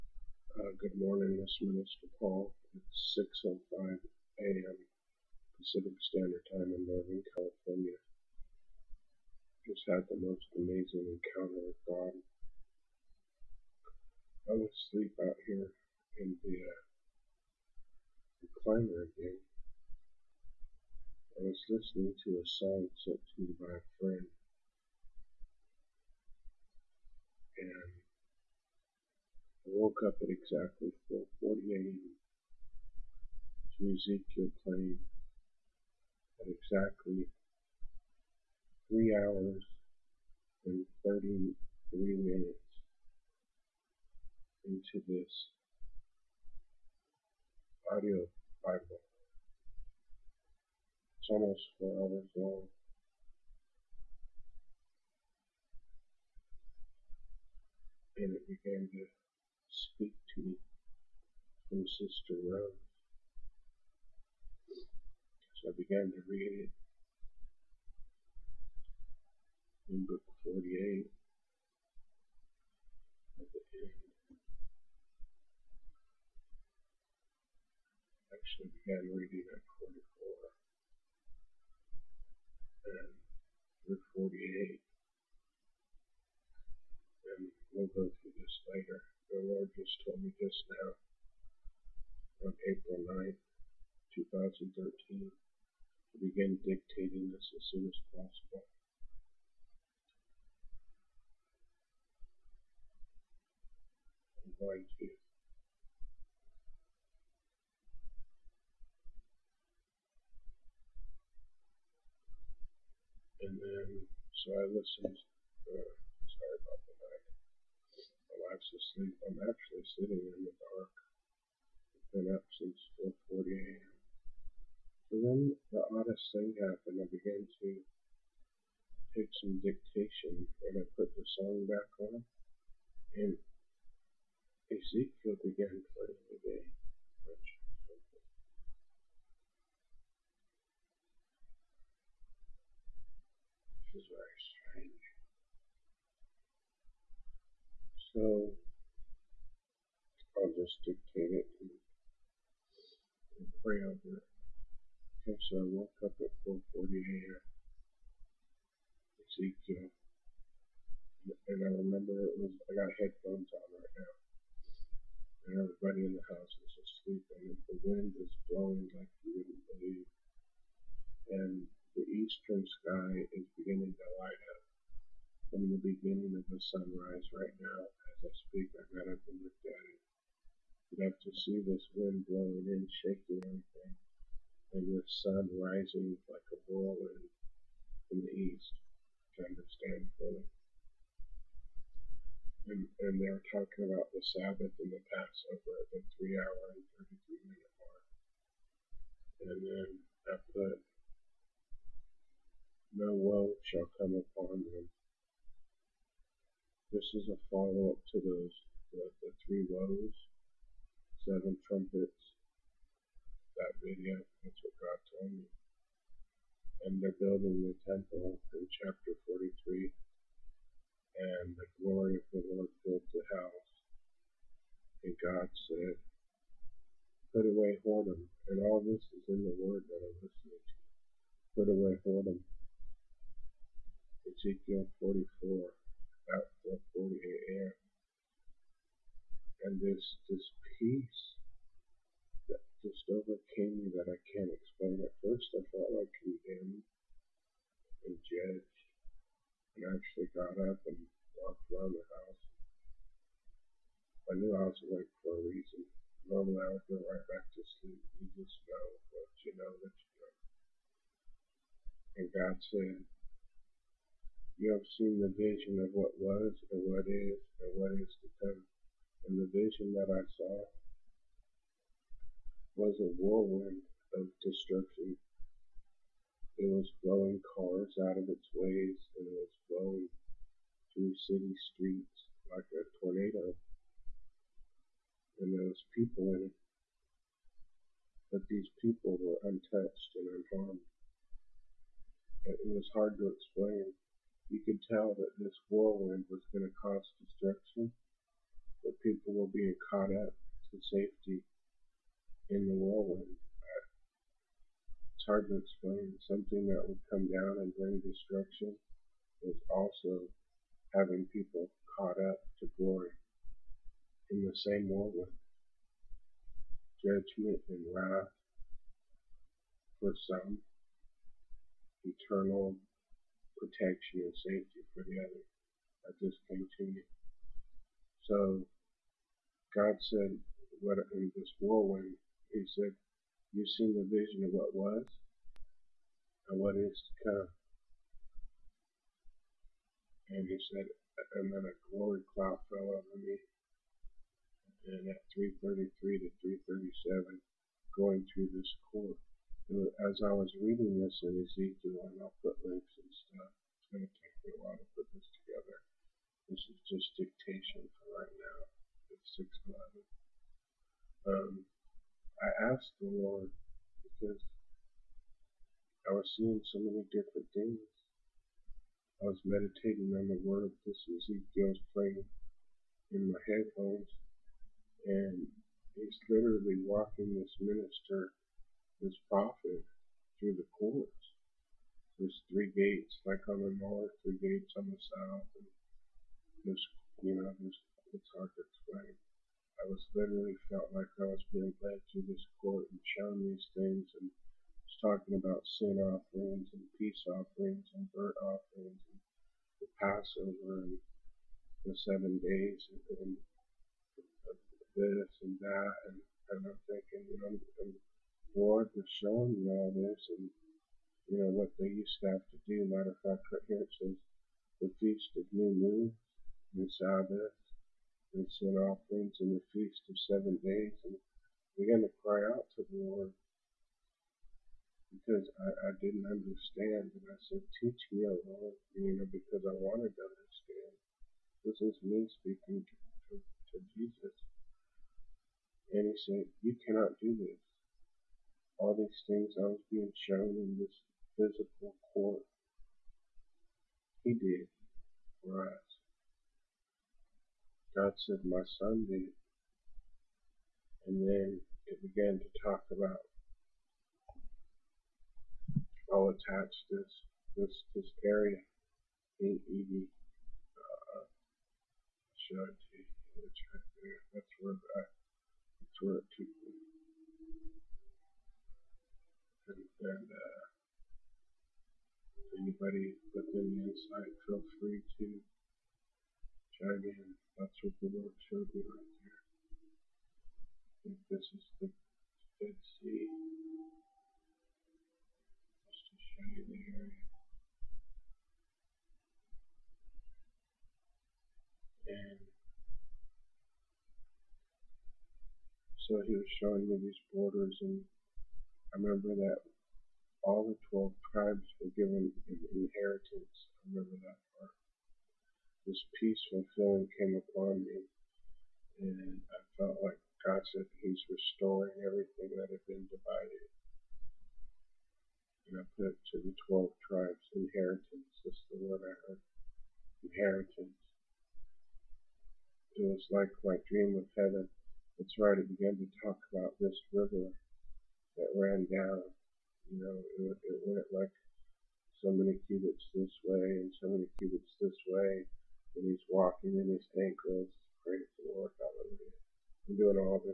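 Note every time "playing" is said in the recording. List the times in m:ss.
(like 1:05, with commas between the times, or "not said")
2:15, 6:11.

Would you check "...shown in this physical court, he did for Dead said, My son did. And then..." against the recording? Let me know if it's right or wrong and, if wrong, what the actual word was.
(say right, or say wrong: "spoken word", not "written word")
wrong: "God", not "Dead".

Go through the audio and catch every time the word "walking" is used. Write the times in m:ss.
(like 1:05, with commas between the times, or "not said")
6:16, 8:56.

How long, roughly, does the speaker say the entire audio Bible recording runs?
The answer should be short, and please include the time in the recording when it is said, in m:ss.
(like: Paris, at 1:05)
almost 4 hours, at 0:51.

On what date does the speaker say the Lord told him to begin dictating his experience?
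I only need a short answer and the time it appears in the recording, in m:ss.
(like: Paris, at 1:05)
April 9th, 2013, at 1:32.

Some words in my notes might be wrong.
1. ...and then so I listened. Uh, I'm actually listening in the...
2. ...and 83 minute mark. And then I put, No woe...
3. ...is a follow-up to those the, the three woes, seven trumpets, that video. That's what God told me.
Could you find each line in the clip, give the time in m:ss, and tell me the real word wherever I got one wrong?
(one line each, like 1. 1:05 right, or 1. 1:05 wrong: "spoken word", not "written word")
1. 1:53 wrong: "sitting", not "listening"
2. 3:16 wrong: "33", not "83"
3. 3:27 right.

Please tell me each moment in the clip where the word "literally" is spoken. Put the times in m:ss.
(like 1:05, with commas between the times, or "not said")
6:16, 6:30.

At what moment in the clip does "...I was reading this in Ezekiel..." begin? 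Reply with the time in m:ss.
5:50.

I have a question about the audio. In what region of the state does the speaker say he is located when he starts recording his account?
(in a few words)
Northern California.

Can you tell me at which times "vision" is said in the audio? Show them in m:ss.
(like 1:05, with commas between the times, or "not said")
4:25, 4:29, 5:34.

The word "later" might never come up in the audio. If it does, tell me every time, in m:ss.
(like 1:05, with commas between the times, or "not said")
1:28.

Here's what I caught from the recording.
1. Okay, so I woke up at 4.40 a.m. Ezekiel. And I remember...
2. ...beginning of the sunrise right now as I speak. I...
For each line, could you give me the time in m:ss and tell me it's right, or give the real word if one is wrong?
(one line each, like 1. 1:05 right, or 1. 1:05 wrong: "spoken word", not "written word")
1. 2:35 right
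2. 2:55 right.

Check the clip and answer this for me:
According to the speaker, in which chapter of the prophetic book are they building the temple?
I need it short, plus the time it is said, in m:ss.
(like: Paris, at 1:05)
chapter 43, at 3:38.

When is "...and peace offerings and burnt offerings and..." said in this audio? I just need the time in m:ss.
6:36.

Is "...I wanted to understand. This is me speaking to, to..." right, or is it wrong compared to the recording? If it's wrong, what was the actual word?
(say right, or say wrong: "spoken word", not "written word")
right.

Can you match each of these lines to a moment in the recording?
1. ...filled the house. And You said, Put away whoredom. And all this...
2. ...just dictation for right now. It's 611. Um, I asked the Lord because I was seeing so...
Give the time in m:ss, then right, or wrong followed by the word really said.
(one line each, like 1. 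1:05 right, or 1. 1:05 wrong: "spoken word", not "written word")
1. 3:42 wrong: "God", not "You"
2. 5:56 right.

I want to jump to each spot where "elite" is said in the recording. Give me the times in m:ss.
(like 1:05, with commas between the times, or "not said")
not said.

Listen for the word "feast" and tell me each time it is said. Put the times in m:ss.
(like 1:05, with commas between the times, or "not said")
6:54, 6:59.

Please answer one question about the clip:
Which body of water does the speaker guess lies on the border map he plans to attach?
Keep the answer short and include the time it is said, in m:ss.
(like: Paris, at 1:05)
the Dead Sea, at 8:01.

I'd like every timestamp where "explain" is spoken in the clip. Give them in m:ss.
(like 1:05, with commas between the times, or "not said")
4:53, 5:05, 6:28.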